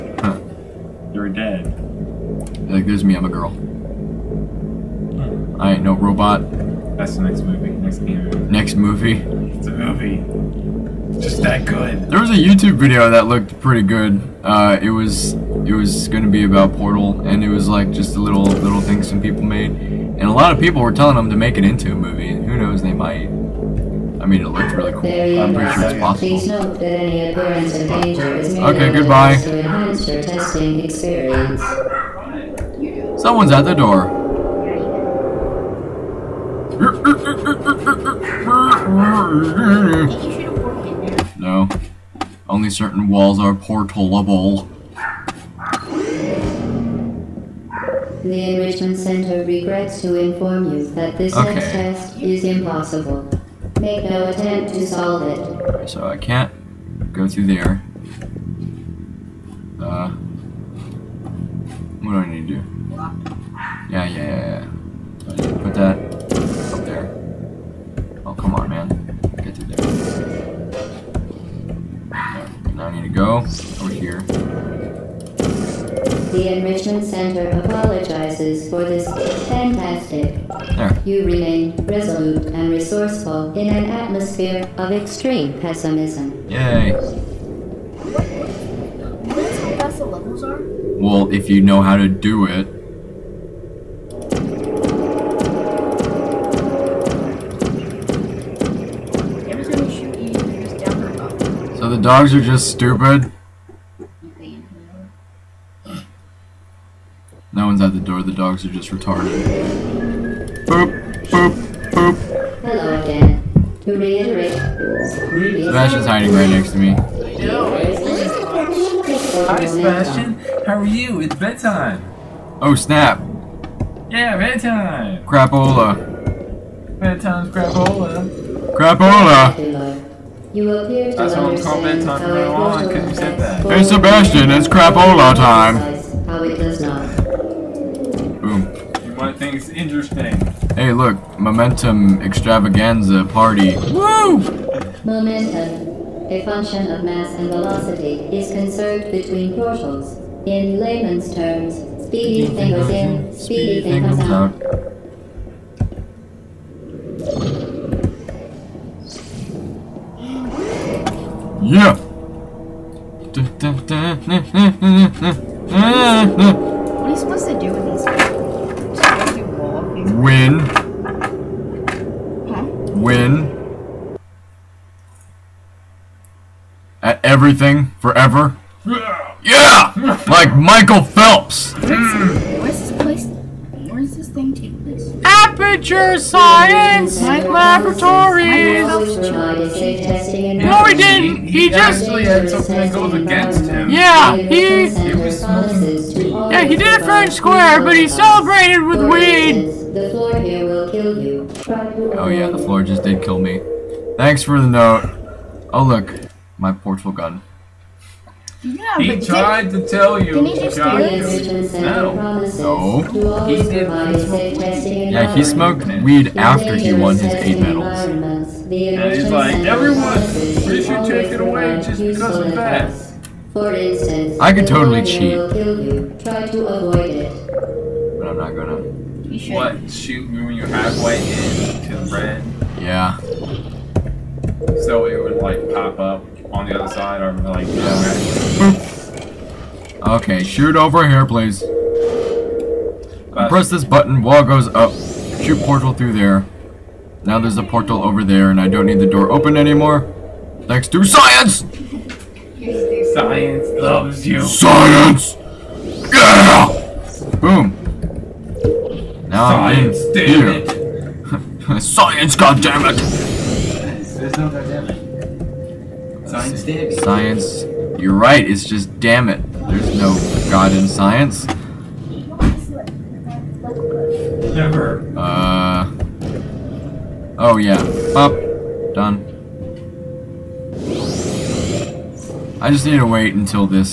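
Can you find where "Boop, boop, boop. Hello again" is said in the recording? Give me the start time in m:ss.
1:50.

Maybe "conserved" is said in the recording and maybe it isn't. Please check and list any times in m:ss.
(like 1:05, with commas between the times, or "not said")
2:28.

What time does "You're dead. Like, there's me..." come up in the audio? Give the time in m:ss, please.
0:01.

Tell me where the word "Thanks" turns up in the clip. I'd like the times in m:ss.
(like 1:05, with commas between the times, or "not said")
3:24, 4:10.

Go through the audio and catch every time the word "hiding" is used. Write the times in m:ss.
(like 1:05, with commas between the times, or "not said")
1:56.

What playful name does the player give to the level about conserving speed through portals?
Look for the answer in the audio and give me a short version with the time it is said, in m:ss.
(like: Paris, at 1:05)
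Momentum Extravaganza Party, at 2:21.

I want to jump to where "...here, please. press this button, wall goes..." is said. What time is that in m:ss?
4:01.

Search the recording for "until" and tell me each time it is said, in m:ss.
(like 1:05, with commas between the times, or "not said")
4:43.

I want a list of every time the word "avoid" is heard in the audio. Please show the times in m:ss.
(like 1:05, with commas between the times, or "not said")
3:46.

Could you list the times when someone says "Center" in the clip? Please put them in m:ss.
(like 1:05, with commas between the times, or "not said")
0:48, 1:17.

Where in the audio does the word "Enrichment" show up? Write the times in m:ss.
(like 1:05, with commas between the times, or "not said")
0:48, 1:16.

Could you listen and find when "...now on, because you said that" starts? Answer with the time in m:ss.
2:12.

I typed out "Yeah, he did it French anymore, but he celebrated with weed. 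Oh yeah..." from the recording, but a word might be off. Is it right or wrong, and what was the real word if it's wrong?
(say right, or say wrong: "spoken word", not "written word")
wrong: "square", not "anymore".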